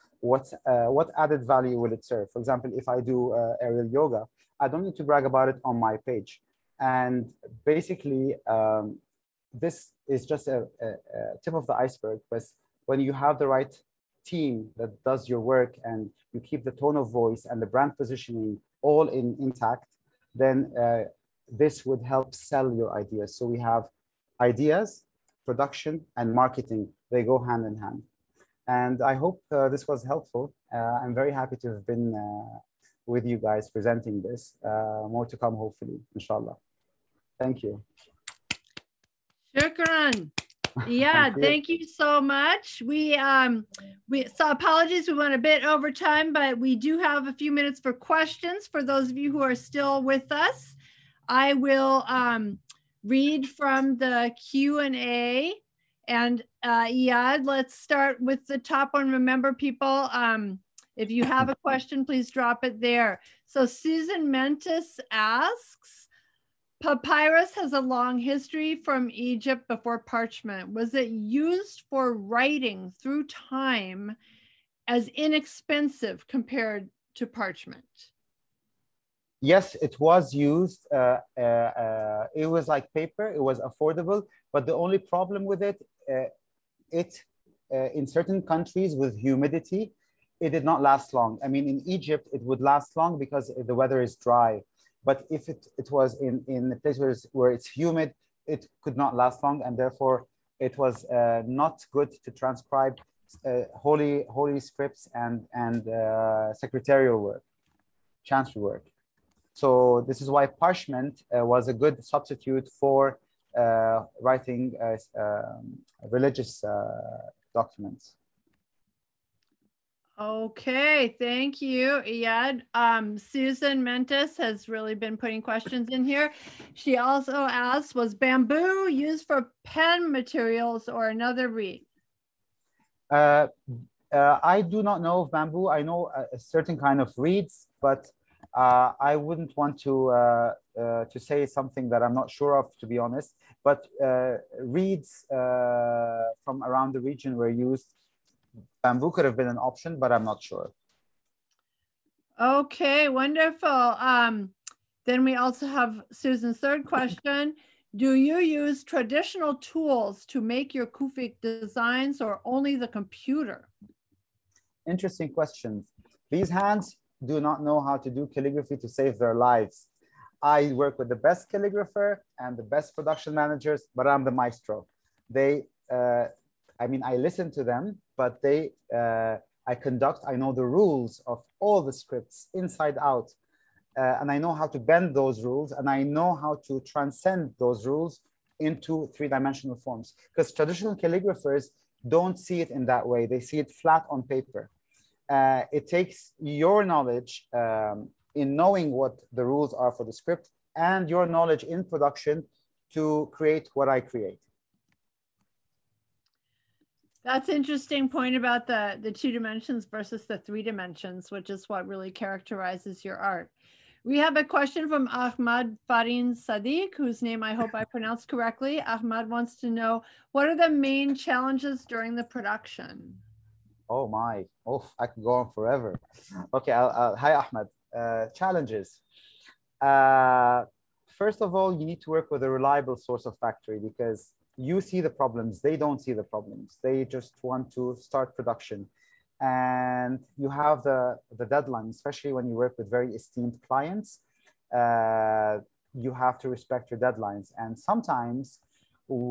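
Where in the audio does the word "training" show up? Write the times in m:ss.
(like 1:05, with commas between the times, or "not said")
not said.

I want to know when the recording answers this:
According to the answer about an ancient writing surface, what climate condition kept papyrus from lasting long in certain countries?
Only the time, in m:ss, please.
1:29.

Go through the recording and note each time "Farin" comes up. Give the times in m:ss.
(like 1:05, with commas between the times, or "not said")
3:35.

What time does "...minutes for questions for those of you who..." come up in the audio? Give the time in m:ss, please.
0:47.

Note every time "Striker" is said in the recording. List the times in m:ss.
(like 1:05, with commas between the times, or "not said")
not said.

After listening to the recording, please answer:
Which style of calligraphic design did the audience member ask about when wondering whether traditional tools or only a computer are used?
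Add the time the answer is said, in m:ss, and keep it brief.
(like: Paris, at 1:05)
Kufic, at 2:40.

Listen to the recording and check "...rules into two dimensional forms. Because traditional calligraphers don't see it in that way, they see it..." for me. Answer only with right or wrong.
wrong.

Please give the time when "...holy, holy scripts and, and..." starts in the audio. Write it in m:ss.
1:43.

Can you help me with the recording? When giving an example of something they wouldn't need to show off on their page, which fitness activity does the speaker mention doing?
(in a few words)
aerial yoga.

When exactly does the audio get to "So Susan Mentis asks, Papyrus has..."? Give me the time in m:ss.
1:03.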